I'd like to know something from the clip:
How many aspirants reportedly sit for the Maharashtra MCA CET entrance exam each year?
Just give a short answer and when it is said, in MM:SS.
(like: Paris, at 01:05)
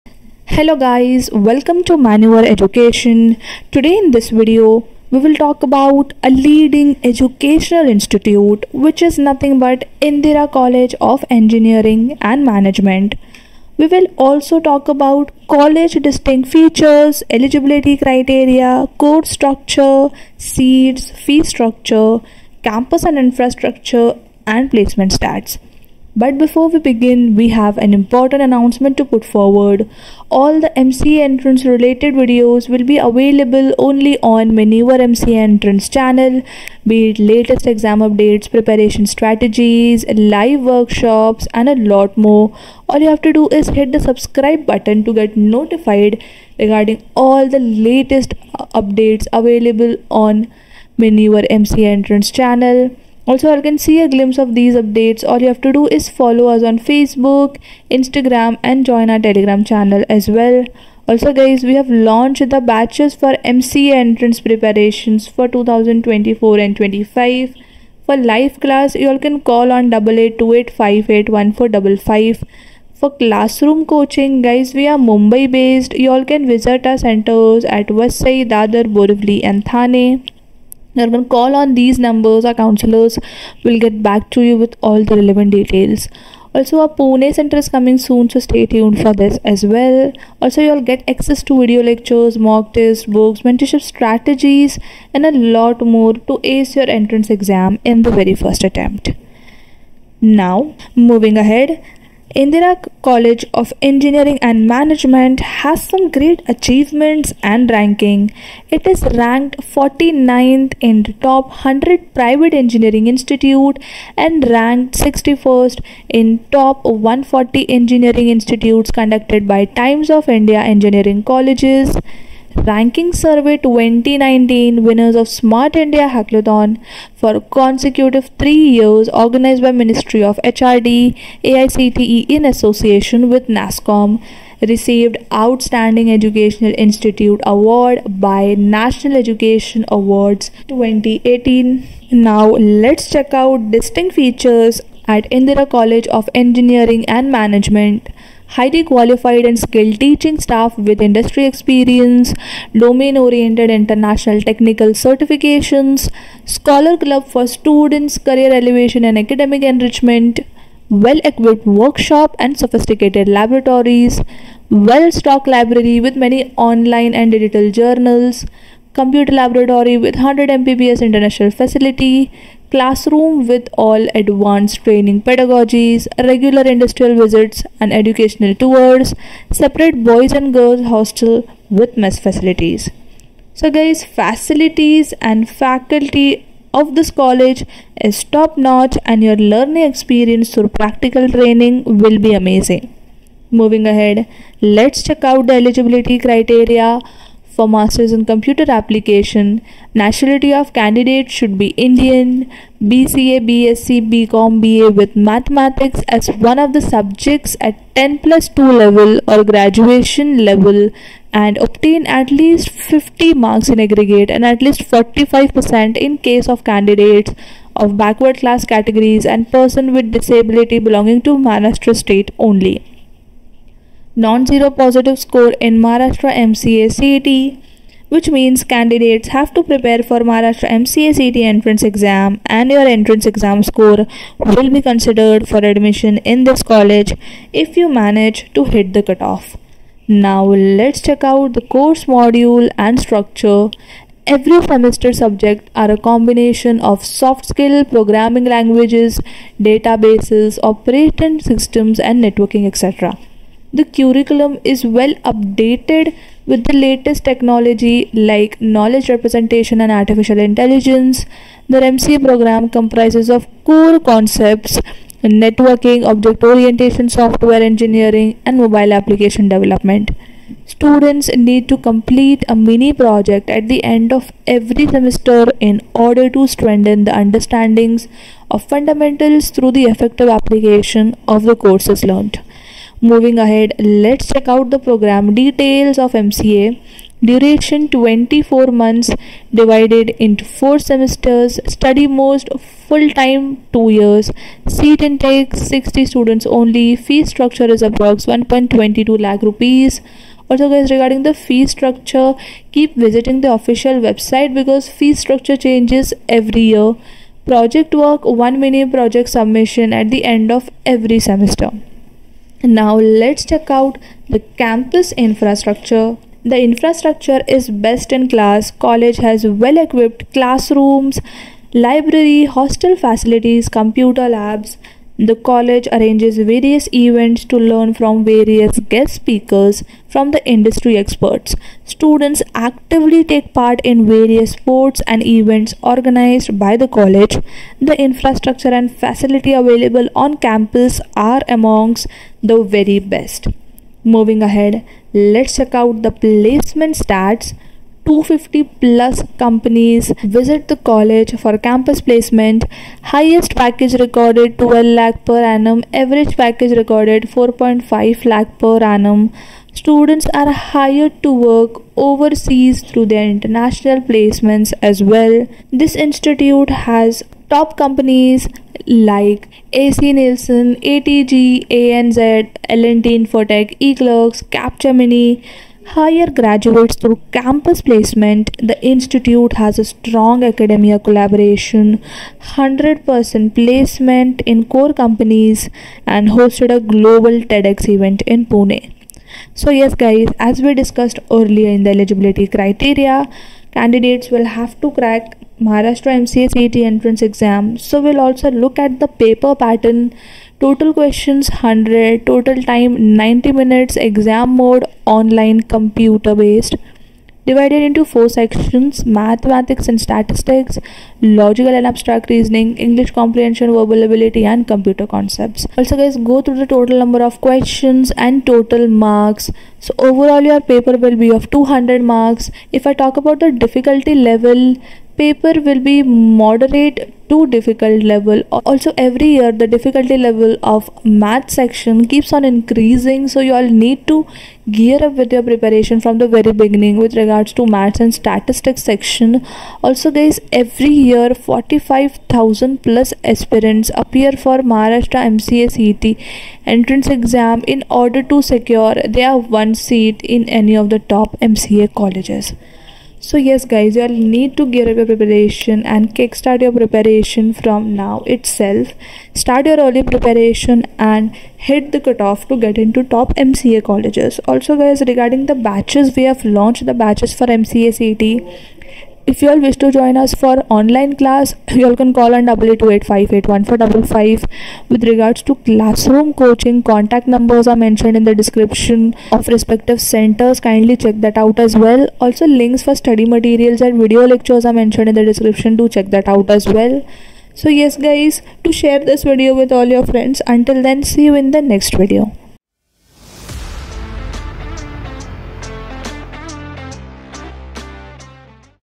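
45000+, at 07:21.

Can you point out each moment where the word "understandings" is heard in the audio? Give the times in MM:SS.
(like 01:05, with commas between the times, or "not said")
04:37.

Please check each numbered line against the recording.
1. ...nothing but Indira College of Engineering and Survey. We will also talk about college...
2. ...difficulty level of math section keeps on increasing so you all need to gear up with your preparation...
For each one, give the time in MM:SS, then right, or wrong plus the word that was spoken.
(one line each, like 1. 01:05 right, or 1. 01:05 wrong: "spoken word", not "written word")
1. 00:09 wrong: "Management", not "Survey"
2. 07:09 right.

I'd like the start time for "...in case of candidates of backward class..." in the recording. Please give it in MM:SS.
03:35.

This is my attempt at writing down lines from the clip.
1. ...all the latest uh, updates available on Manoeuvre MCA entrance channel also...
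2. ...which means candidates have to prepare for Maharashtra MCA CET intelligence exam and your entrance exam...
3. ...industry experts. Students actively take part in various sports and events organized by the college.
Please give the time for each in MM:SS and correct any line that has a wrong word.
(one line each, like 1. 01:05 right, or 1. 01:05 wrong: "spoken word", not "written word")
1. 00:47 right
2. 03:48 wrong: "entrance", not "intelligence"
3. 05:30 right.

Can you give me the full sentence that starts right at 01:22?
Our counselors will get back to you with all the relevant details.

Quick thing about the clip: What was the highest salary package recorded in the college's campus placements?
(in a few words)
12 lakh per annum.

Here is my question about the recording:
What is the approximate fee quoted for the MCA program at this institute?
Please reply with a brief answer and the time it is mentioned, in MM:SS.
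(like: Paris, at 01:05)
1.22 lakh rupees, at 04:58.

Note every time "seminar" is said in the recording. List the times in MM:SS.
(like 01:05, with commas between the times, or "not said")
not said.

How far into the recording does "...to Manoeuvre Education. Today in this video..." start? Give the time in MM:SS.
00:01.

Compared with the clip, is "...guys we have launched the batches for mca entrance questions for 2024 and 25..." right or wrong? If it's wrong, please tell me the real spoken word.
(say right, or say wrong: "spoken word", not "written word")
wrong: "preparations", not "questions".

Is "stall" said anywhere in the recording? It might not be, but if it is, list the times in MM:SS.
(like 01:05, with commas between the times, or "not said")
not said.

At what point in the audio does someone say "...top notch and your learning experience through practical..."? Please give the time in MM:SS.
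03:08.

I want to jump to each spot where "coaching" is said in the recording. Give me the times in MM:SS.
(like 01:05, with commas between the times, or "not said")
01:13, 07:56.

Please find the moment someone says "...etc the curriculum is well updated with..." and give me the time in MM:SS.
04:12.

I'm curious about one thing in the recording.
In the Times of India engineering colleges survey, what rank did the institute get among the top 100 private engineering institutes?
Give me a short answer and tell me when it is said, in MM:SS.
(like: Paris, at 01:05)
49th, at 01:49.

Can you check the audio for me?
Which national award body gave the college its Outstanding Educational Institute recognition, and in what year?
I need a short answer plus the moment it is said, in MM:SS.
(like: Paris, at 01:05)
National Education Awards 2018, at 02:18.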